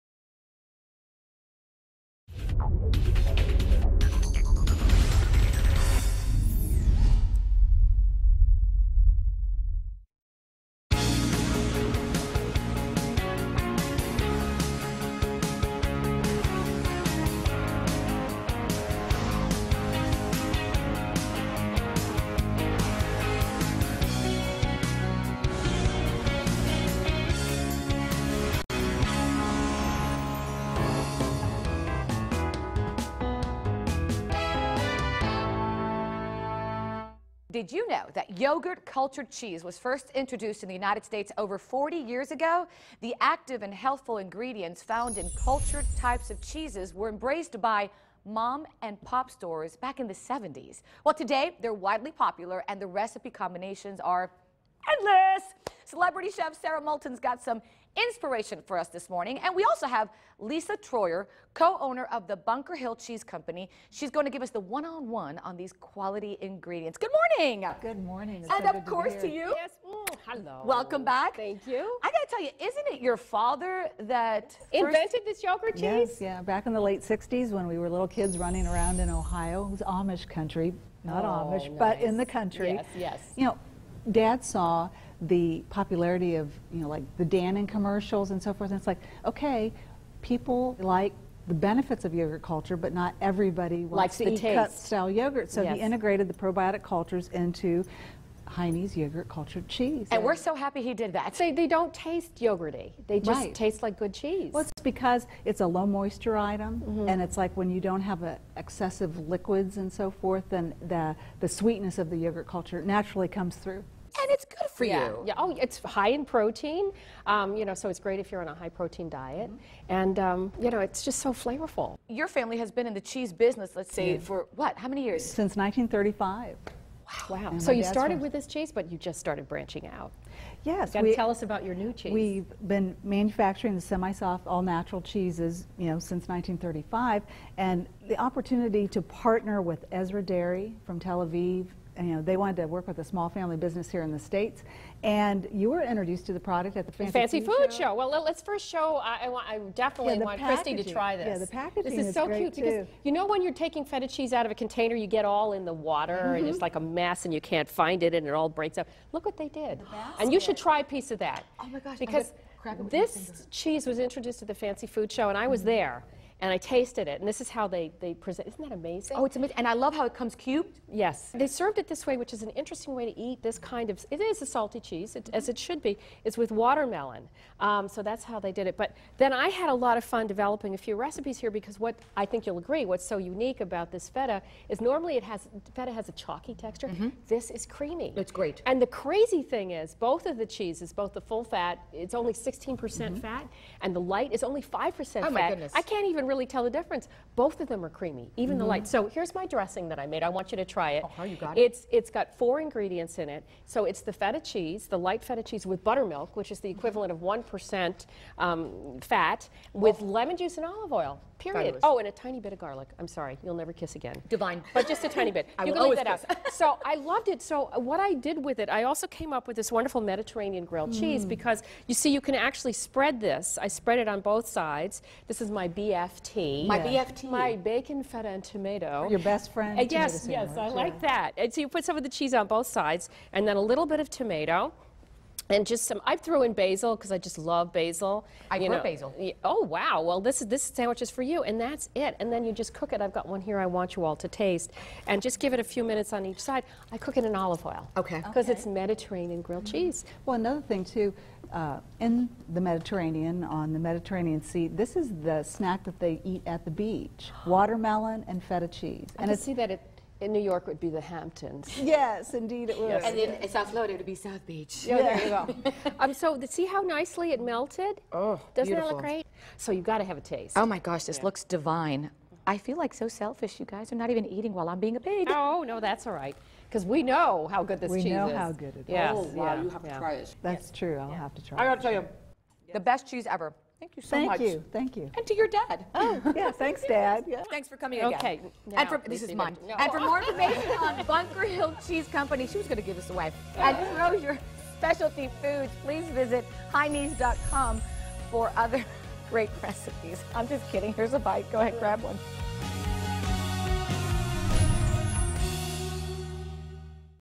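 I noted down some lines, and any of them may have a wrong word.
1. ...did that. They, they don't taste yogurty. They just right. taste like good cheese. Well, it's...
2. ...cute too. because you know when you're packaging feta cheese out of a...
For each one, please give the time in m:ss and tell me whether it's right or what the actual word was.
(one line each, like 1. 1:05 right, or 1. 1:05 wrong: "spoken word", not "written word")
1. 1:40 right
2. 2:32 wrong: "taking", not "packaging".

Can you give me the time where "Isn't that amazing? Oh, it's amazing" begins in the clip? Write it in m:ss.
2:48.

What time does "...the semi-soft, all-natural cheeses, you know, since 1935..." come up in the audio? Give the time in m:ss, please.
2:13.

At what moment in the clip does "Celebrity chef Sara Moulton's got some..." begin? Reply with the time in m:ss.
0:55.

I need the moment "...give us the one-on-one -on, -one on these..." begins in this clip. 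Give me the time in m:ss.
1:04.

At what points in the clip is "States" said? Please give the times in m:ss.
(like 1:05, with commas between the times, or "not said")
0:41, 2:24.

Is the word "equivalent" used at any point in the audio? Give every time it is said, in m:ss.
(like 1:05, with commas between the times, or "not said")
3:26.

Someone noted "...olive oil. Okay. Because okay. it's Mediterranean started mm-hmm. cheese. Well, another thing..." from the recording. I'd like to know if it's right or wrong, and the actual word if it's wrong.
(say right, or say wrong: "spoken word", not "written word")
wrong: "grilled", not "started".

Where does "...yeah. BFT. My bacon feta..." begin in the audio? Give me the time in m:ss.
3:46.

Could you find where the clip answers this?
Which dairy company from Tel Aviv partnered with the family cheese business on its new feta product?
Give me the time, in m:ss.
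2:20.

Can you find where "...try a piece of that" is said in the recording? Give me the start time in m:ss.
2:40.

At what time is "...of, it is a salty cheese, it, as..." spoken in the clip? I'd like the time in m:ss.
2:53.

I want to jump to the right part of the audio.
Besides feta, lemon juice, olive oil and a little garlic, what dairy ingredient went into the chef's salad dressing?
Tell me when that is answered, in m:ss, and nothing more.
3:25.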